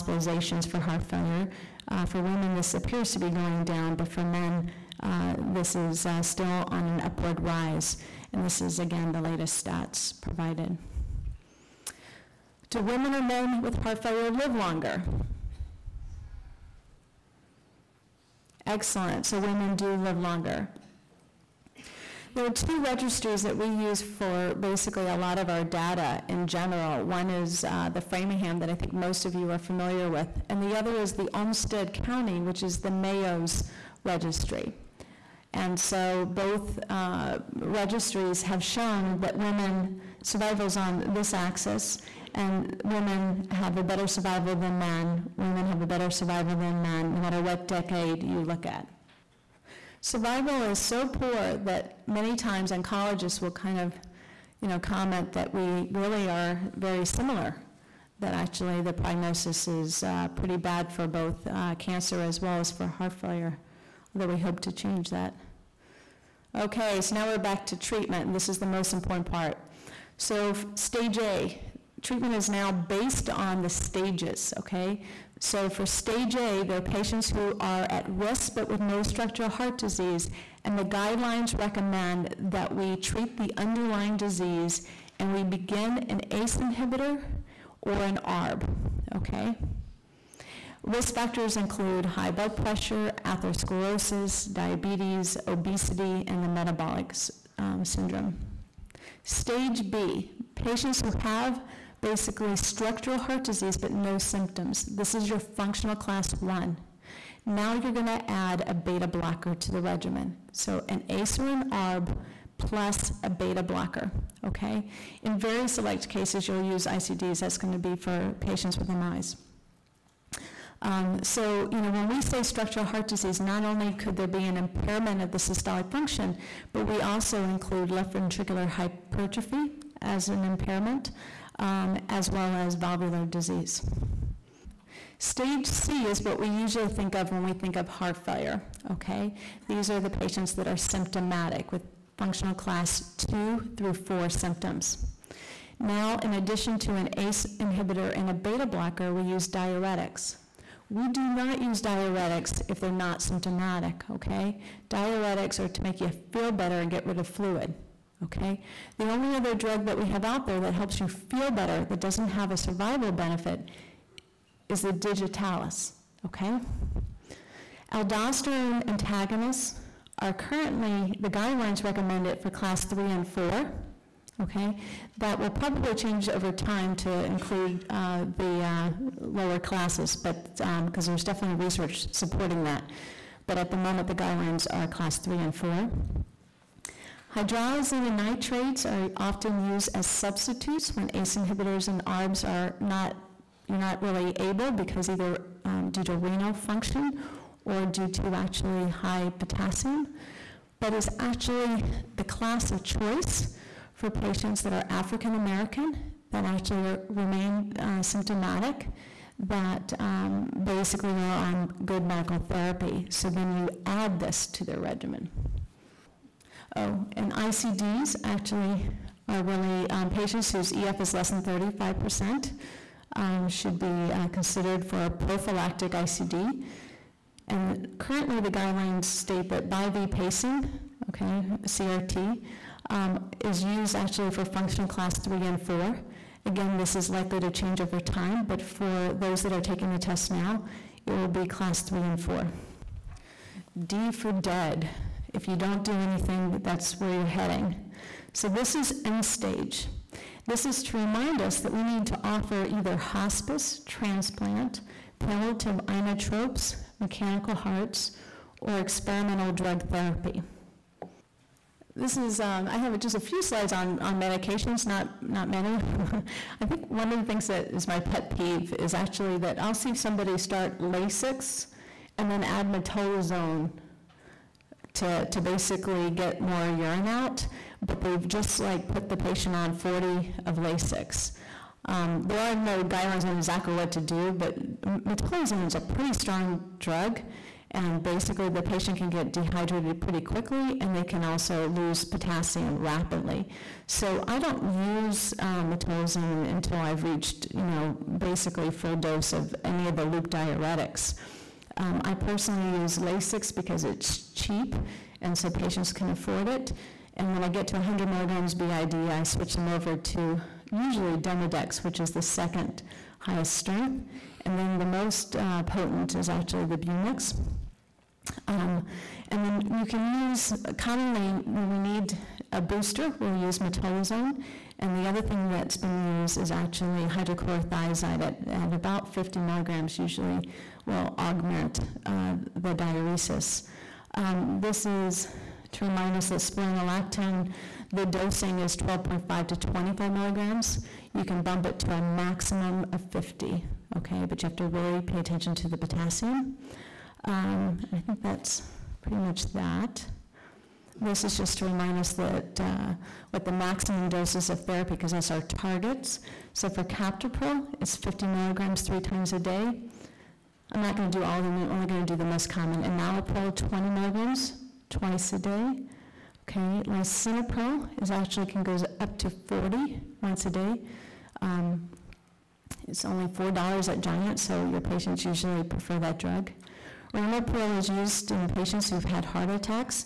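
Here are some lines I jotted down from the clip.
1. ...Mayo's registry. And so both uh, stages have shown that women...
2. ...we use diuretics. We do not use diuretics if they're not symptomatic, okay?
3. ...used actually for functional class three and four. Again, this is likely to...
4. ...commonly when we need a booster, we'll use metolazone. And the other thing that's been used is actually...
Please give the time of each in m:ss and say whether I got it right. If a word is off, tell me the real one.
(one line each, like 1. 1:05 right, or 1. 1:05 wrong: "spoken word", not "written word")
1. 0:32 wrong: "registries", not "stages"
2. 2:29 right
3. 3:53 right
4. 5:20 right.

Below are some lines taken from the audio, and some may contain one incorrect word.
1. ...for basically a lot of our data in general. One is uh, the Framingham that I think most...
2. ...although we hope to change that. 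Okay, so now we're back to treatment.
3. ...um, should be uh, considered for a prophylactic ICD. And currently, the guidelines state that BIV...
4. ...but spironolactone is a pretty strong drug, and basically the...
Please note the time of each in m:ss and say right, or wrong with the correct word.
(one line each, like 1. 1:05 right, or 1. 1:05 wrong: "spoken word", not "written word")
1. 0:24 right
2. 1:04 right
3. 3:43 right
4. 4:44 wrong: "metolazone", not "spironolactone".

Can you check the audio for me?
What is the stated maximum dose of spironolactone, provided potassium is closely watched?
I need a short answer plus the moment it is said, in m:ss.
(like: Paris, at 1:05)
50 milligrams, at 5:42.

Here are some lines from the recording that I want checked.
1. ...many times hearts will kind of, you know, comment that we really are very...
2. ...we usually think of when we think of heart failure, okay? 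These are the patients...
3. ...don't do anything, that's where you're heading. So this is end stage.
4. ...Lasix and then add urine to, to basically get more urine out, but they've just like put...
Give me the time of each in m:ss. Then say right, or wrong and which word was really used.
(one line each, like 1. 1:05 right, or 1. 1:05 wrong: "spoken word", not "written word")
1. 0:52 wrong: "oncologists", not "hearts"
2. 2:16 right
3. 4:05 right
4. 4:30 wrong: "metolazone", not "urine".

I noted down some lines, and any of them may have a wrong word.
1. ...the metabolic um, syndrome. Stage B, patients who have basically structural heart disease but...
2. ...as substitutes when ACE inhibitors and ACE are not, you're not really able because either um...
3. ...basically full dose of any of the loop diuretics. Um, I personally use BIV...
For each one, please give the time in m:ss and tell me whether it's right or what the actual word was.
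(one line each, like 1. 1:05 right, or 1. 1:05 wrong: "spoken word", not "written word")
1. 1:36 right
2. 3:09 wrong: "ARBs", not "ACE"
3. 4:58 wrong: "Lasix", not "BIV".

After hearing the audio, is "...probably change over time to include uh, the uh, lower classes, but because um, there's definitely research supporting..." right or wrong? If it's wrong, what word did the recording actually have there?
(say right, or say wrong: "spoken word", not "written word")
right.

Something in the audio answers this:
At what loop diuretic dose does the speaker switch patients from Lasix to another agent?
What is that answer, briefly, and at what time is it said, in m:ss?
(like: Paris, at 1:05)
100 milligrams BID, at 5:07.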